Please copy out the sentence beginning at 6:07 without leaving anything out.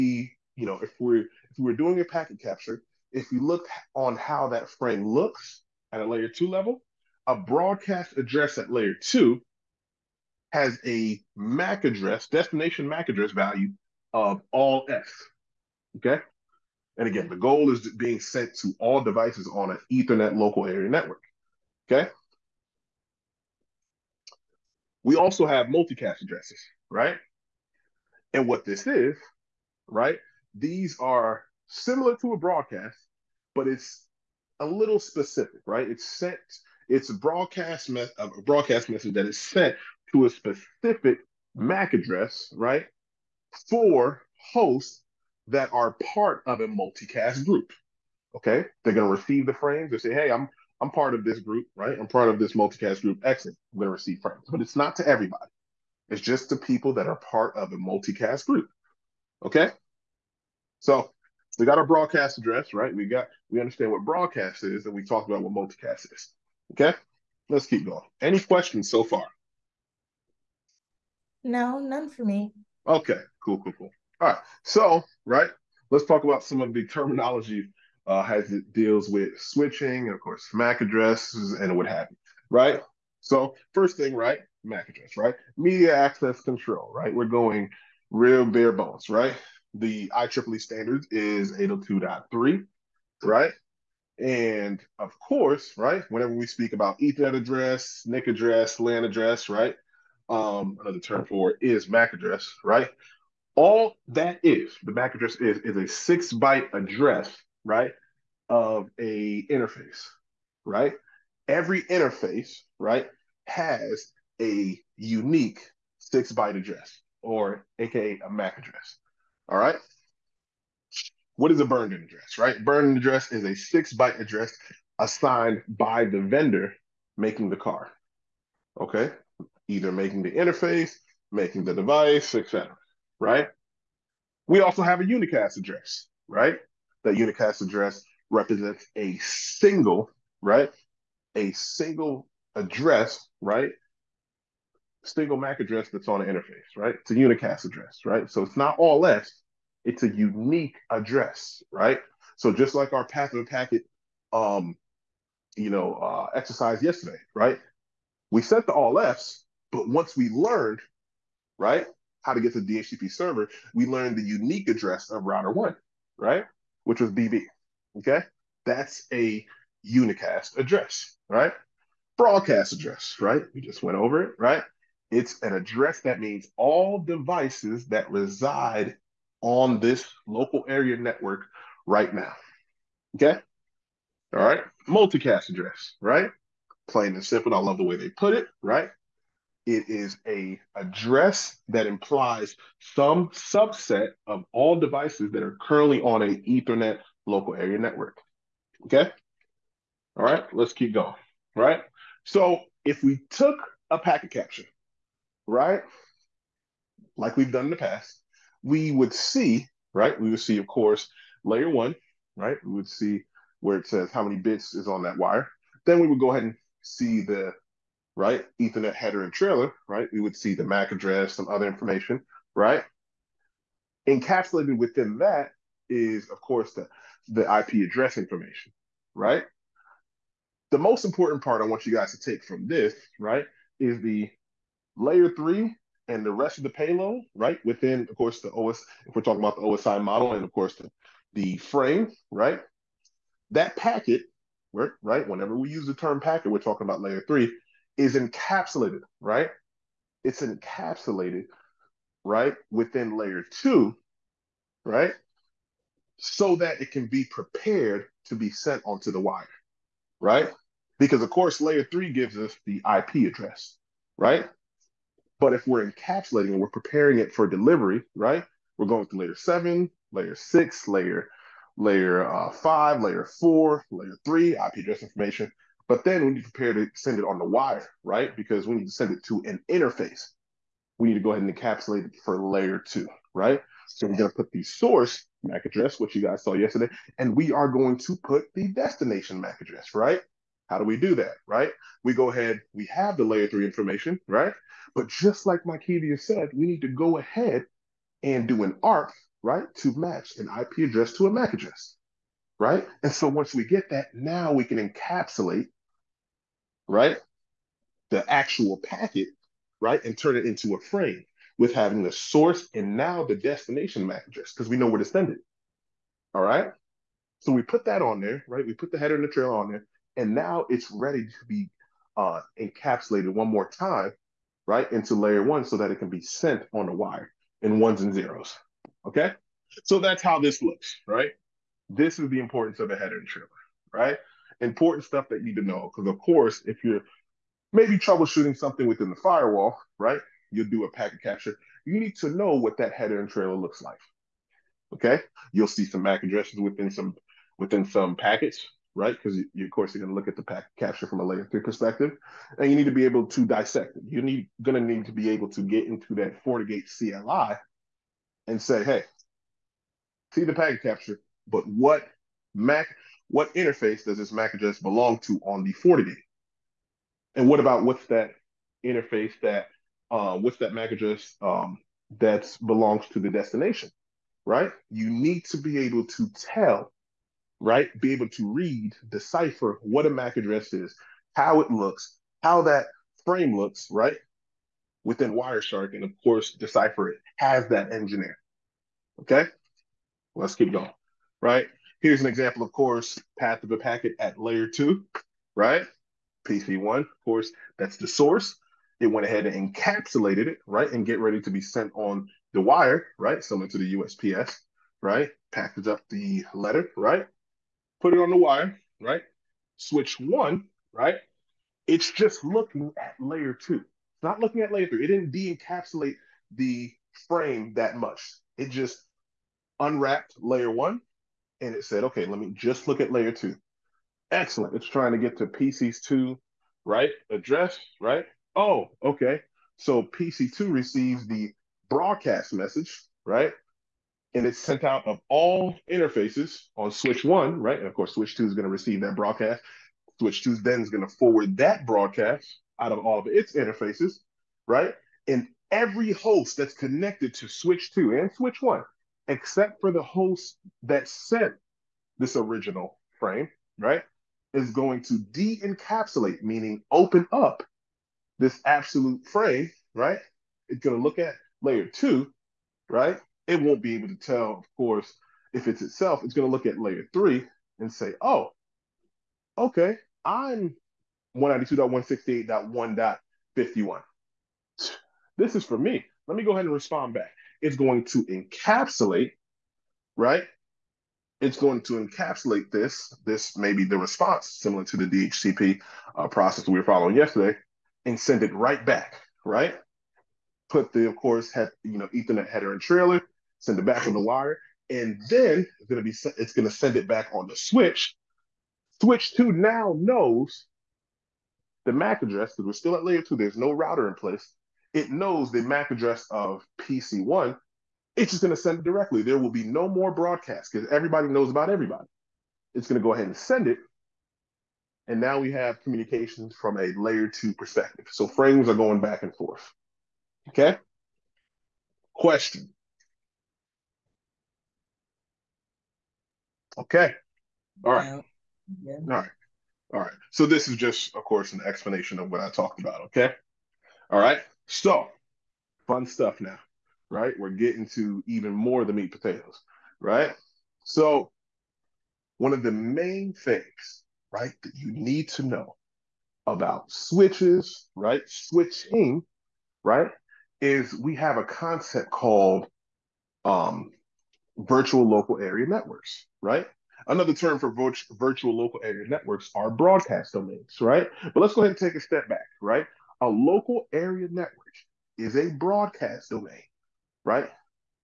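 And what about what's that interface that uh, what's that MAC address um, that belongs to the destination, right?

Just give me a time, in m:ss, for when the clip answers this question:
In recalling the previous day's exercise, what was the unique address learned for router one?
2:47.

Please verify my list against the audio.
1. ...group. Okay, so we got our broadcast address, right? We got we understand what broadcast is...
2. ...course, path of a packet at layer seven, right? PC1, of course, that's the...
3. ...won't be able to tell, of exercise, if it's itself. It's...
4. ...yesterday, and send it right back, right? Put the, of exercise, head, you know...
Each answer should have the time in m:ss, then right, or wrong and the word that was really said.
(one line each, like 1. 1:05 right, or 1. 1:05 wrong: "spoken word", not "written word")
1. 0:58 right
2. 6:32 wrong: "two", not "seven"
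3. 7:43 wrong: "course", not "exercise"
4. 8:07 wrong: "course", not "exercise".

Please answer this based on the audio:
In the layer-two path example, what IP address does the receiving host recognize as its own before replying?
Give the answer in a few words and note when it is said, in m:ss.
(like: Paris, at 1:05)
192.168.1.51, at 7:51.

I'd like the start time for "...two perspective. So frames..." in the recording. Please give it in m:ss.
8:37.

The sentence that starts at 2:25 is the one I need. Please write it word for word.
Single MAC address that's on an interface, right?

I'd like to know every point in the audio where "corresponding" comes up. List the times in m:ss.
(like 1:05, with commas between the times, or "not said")
not said.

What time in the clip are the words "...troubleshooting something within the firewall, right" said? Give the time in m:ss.
5:37.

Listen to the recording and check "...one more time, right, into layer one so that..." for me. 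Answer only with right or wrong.
right.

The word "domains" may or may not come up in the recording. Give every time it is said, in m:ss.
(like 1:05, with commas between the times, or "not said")
9:20, 9:26.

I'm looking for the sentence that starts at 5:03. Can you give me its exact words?
And so once we get that, now we can encapsulate right?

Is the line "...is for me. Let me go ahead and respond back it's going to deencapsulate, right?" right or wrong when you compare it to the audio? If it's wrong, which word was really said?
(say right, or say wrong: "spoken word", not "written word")
wrong: "encapsulate", not "deencapsulate".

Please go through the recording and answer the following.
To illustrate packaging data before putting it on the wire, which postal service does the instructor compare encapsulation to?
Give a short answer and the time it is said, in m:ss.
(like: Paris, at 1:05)
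USPS, at 6:43.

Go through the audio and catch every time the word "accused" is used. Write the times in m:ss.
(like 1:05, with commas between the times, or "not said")
not said.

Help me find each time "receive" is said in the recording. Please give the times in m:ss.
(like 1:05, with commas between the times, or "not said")
0:49, 0:53, 7:10, 7:18.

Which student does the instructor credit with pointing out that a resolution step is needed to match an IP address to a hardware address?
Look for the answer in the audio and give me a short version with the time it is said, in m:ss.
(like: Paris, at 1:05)
Mykevia, at 4:55.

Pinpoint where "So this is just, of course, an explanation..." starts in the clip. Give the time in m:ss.
8:50.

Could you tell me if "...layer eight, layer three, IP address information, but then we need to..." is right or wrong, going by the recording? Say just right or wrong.
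wrong.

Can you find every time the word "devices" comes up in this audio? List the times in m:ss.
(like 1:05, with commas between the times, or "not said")
0:18, 2:11, 2:56, 3:14.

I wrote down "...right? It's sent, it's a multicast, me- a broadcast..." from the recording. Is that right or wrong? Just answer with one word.
wrong.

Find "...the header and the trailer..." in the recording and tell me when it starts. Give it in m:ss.
5:18.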